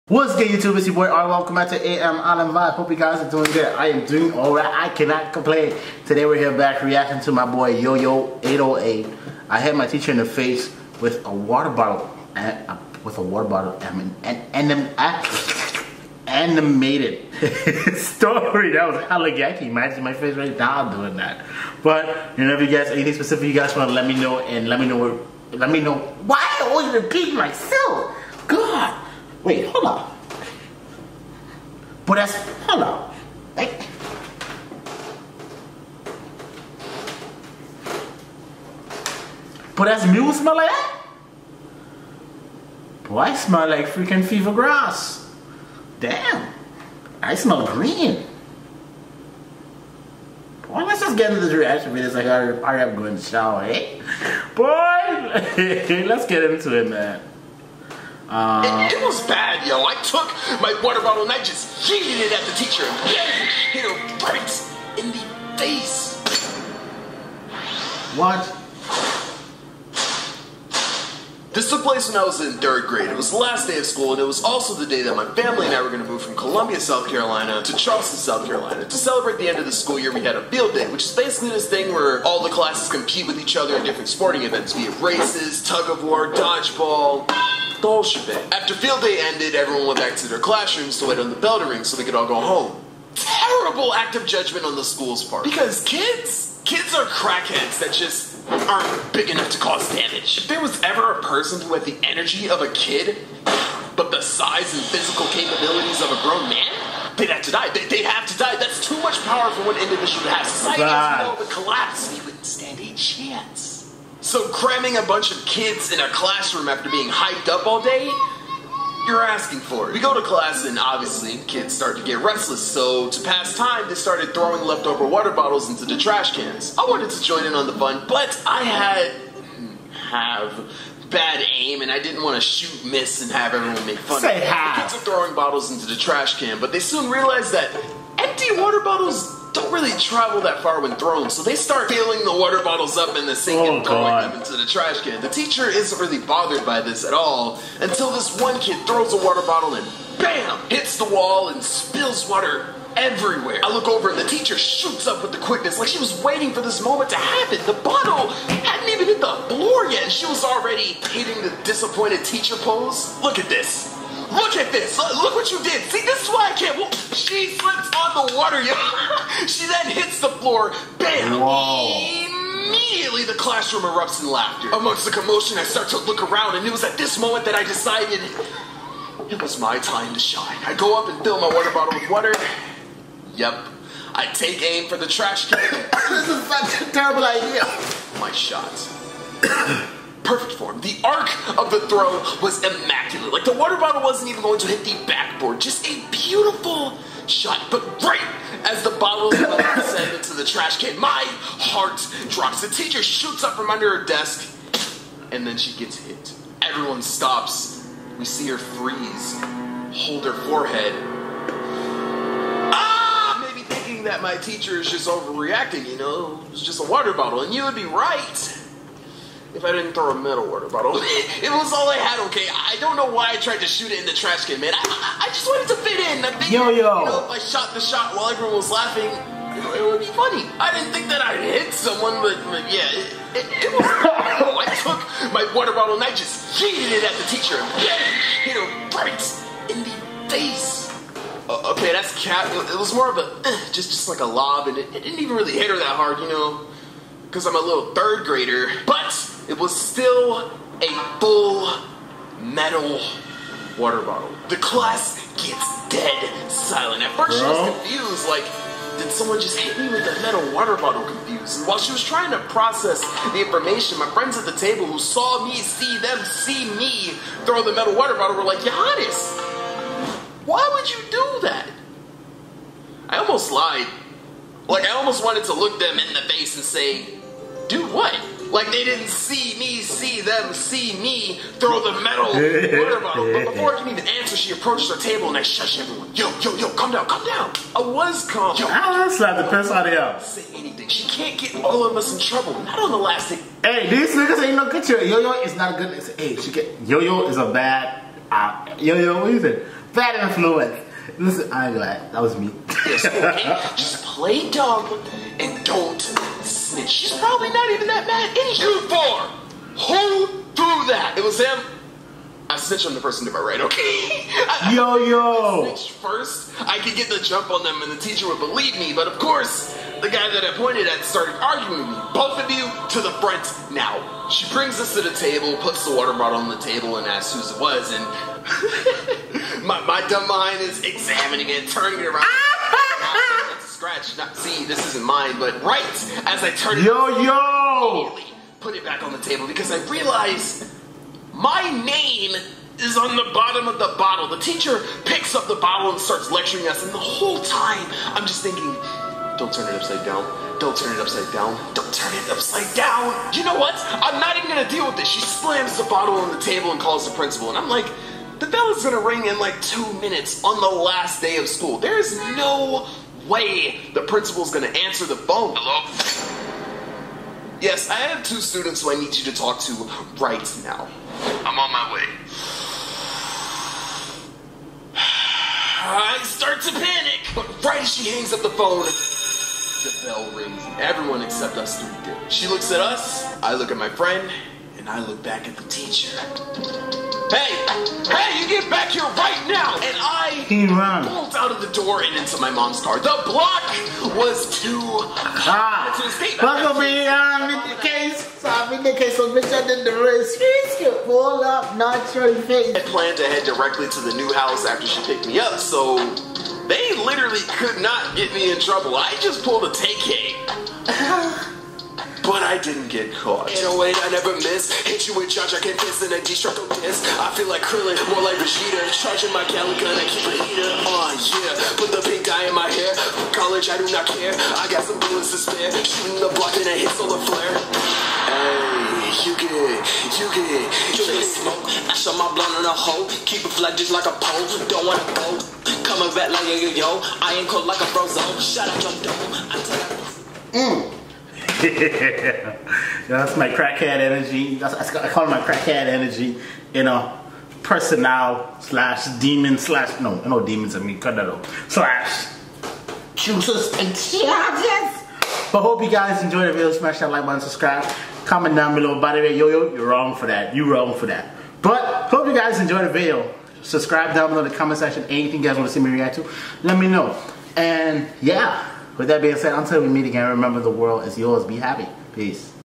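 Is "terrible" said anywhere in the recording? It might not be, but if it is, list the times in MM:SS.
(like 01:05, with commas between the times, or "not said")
01:33, 03:06.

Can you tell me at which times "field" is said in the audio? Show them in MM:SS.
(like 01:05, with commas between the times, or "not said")
01:20, 01:28.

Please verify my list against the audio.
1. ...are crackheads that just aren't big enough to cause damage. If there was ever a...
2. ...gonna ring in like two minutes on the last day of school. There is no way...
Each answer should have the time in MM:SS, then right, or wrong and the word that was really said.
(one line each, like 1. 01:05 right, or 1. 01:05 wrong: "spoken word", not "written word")
1. 01:36 right
2. 05:58 right.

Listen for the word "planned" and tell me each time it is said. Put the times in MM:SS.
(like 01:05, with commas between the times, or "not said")
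06:42.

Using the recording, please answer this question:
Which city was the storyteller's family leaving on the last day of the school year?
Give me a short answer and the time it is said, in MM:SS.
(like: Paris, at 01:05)
Columbia, South Carolina, at 01:16.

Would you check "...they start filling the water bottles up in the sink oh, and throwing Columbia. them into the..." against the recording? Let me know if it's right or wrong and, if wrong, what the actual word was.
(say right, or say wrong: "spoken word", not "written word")
wrong: "God", not "Columbia".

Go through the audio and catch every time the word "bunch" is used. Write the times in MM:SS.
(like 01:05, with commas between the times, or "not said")
01:55.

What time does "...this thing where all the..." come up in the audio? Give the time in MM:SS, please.
01:21.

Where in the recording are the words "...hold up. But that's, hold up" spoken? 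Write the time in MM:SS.
00:29.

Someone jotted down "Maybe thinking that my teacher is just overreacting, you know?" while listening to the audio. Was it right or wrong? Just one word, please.
right.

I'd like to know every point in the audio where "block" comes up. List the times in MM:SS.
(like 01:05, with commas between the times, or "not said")
06:33, 07:06.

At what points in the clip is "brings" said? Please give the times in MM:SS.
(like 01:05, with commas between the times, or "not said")
05:24.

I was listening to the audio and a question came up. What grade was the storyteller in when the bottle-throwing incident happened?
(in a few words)
Third grade.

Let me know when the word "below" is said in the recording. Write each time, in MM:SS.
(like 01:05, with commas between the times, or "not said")
07:38, 07:44.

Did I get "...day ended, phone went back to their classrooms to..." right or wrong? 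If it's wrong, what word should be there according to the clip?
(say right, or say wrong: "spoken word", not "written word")
wrong: "everyone", not "phone".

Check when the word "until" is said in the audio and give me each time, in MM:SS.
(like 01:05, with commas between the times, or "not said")
02:27, 07:49.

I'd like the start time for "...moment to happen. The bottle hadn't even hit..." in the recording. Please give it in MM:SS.
02:36.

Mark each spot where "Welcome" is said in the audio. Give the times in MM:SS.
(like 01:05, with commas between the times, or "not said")
00:01.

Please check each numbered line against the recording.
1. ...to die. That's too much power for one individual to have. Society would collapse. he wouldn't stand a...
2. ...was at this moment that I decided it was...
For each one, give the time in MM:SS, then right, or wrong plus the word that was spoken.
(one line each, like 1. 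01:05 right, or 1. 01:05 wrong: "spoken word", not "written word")
1. 01:48 right
2. 02:56 right.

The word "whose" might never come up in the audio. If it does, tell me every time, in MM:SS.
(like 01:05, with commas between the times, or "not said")
05:27.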